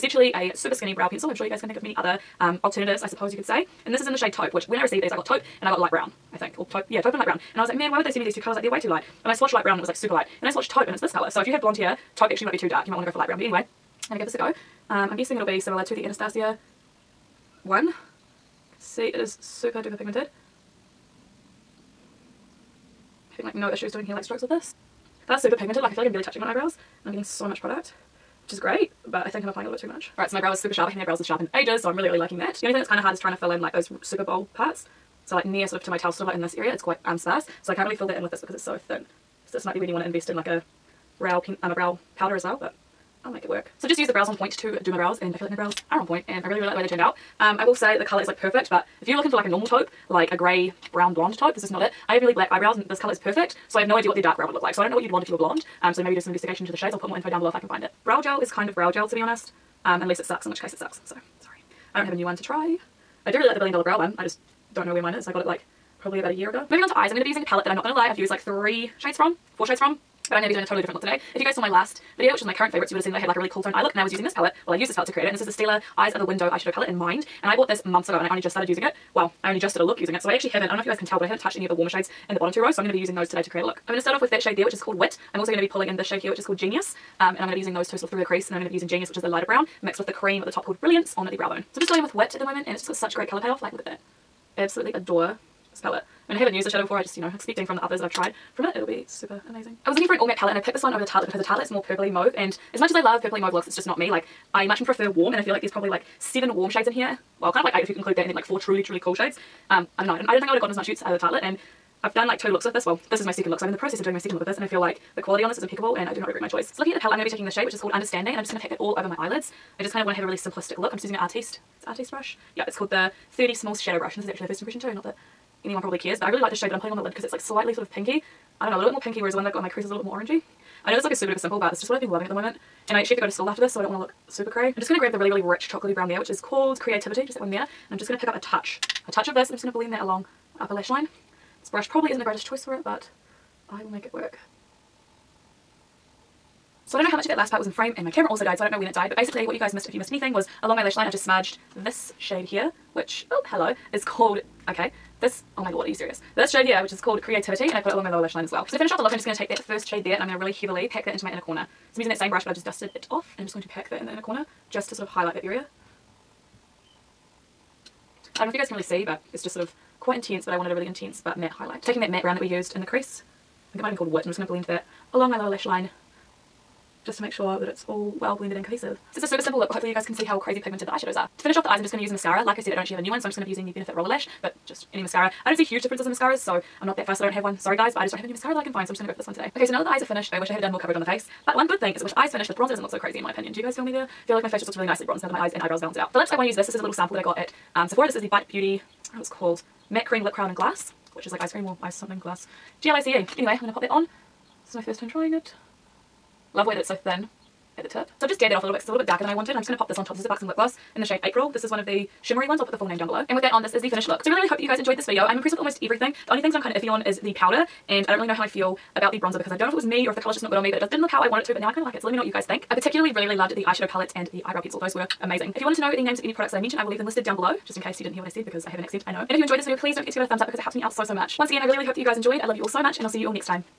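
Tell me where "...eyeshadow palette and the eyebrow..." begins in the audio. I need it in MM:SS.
03:43.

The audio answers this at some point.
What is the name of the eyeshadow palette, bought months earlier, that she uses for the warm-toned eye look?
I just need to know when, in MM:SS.
01:15.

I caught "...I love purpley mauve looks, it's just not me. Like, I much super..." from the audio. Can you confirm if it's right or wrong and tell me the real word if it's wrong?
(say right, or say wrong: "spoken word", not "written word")
wrong: "prefer", not "super".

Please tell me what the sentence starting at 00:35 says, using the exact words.
So like near sort of to my towel, sort of like in this area, it's quite um, sparse.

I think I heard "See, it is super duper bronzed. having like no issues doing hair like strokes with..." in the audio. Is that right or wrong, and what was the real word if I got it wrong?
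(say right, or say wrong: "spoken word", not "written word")
wrong: "pigmented", not "bronzed".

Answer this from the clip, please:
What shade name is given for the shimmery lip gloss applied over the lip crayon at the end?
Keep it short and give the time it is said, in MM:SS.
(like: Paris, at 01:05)
April, at 03:31.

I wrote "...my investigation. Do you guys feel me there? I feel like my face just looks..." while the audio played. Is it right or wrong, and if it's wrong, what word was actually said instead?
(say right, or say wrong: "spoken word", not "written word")
wrong: "opinion", not "investigation".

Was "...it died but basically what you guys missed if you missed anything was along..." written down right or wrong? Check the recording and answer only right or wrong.
right.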